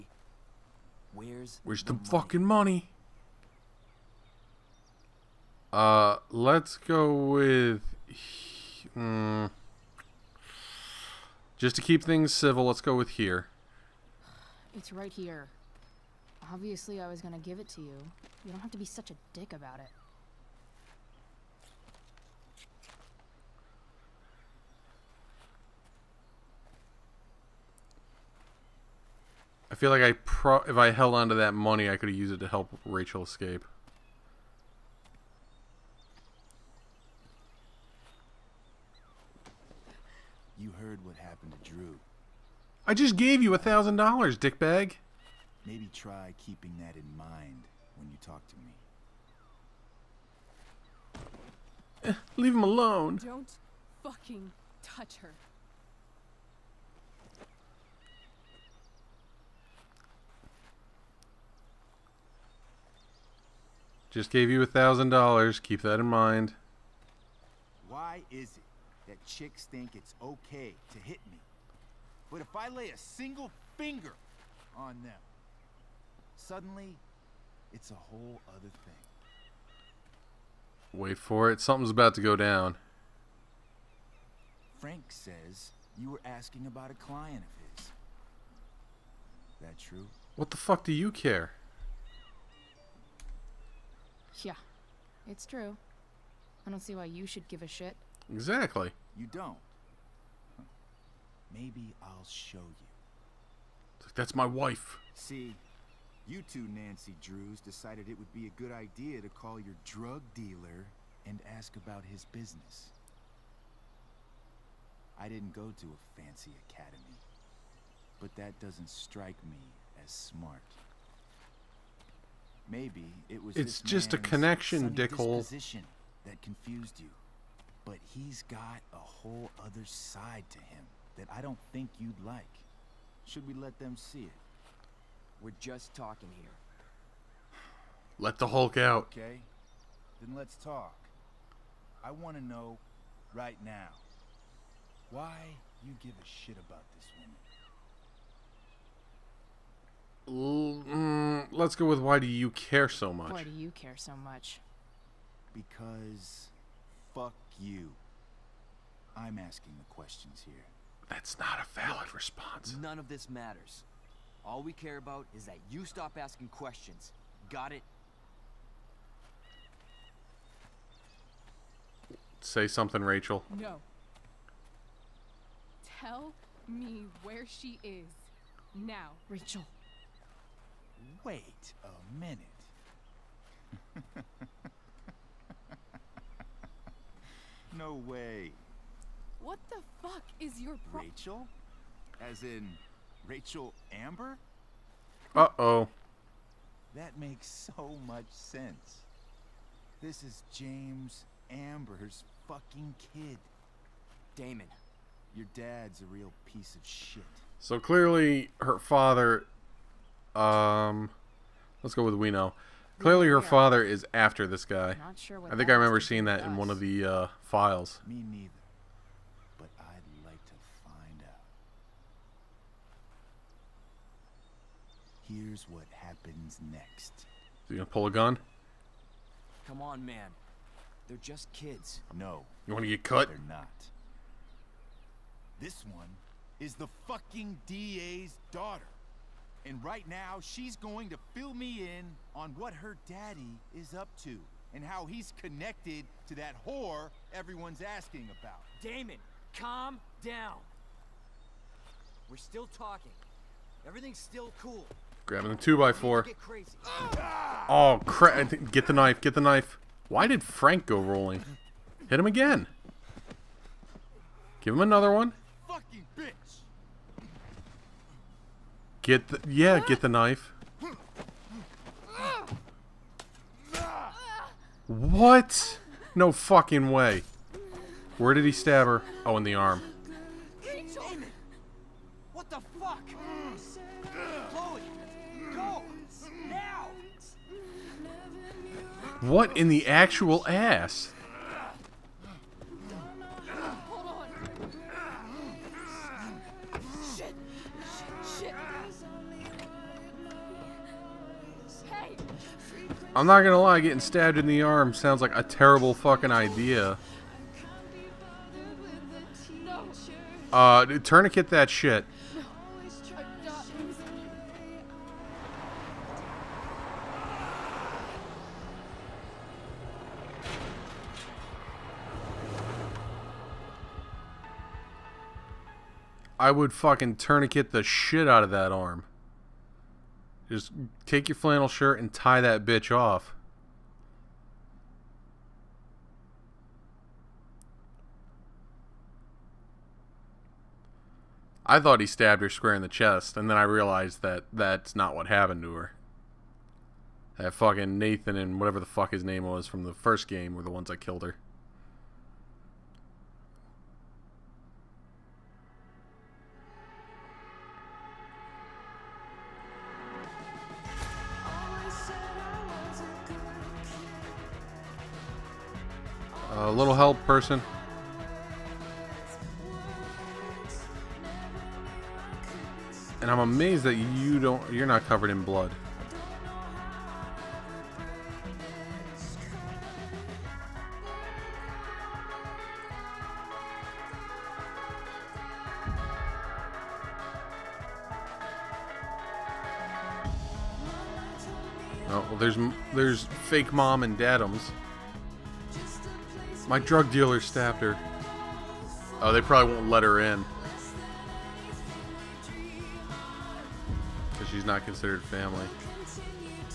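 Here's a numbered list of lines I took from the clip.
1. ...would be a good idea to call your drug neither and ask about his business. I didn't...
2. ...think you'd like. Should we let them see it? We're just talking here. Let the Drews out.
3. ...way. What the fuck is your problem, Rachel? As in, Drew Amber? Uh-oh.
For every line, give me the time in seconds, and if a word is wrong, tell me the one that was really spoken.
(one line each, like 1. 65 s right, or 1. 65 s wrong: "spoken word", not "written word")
1. 108 s wrong: "dealer", not "neither"
2. 131 s wrong: "Hulk", not "Drews"
3. 188 s wrong: "Rachel", not "Drew".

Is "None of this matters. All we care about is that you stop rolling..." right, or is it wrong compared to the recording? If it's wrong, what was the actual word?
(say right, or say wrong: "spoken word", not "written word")
wrong: "asking", not "rolling".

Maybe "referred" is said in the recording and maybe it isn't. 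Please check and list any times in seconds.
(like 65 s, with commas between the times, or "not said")
not said.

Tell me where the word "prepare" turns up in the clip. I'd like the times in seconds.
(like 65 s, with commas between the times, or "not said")
not said.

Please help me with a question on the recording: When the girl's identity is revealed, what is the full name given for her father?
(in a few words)
James Amber.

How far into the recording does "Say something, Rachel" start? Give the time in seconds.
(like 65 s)
172 s.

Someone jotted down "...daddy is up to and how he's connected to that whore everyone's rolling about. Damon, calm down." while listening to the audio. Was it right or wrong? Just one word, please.
wrong.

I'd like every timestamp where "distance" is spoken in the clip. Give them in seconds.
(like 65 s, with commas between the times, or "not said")
not said.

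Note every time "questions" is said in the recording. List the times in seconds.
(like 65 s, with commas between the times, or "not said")
159 s, 166 s.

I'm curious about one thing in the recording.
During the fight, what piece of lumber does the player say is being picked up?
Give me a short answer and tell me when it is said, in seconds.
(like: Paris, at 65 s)
2x4, at 255 s.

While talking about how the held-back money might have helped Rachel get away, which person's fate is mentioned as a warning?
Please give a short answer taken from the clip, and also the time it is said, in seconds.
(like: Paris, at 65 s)
Drew, at 41 s.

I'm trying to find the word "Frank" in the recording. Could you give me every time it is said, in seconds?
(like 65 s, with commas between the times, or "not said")
84 s, 260 s.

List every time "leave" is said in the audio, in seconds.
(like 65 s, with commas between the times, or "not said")
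52 s.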